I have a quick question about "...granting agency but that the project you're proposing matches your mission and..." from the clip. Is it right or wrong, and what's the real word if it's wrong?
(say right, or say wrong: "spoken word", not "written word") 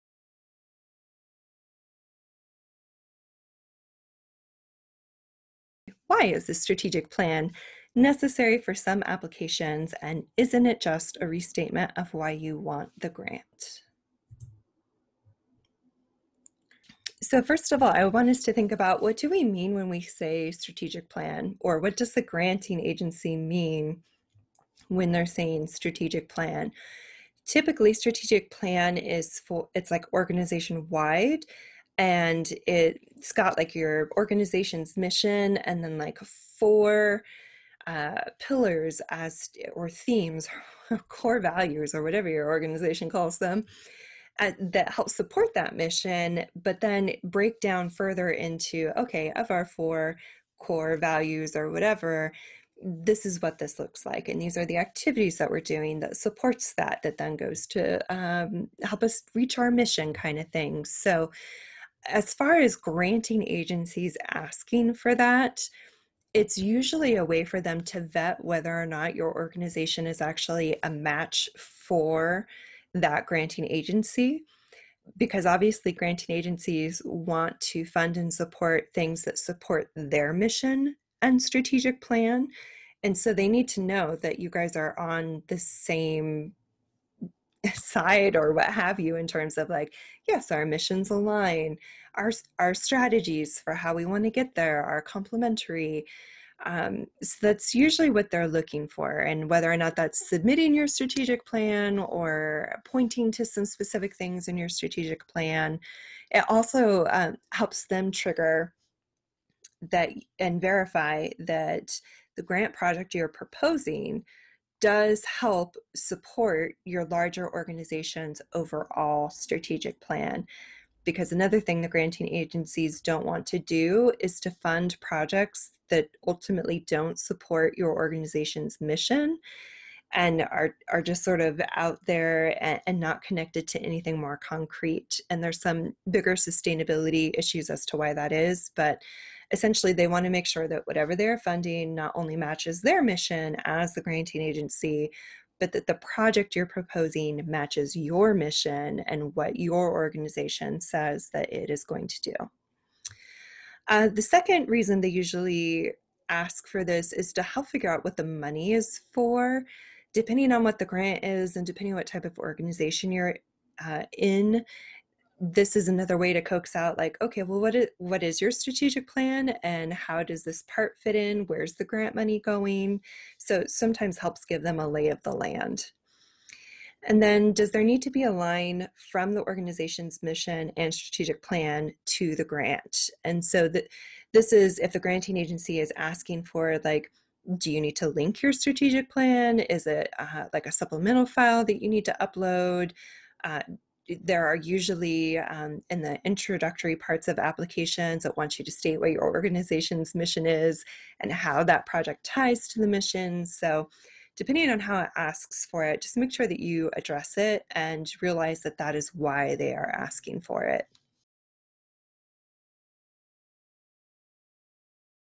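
right.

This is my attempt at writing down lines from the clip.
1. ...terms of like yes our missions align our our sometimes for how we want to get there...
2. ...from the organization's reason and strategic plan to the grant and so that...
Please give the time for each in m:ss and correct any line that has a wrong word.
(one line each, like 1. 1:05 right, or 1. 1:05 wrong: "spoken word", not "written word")
1. 1:29 wrong: "strategies", not "sometimes"
2. 2:59 wrong: "mission", not "reason".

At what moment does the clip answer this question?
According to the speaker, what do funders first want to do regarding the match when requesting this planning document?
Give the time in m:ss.
1:08.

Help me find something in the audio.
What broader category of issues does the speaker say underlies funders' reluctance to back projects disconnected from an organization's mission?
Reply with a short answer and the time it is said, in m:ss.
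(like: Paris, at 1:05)
Sustainability issues, at 2:16.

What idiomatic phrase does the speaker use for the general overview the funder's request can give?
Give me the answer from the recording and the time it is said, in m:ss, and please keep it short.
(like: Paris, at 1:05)
Lay of the land, at 2:54.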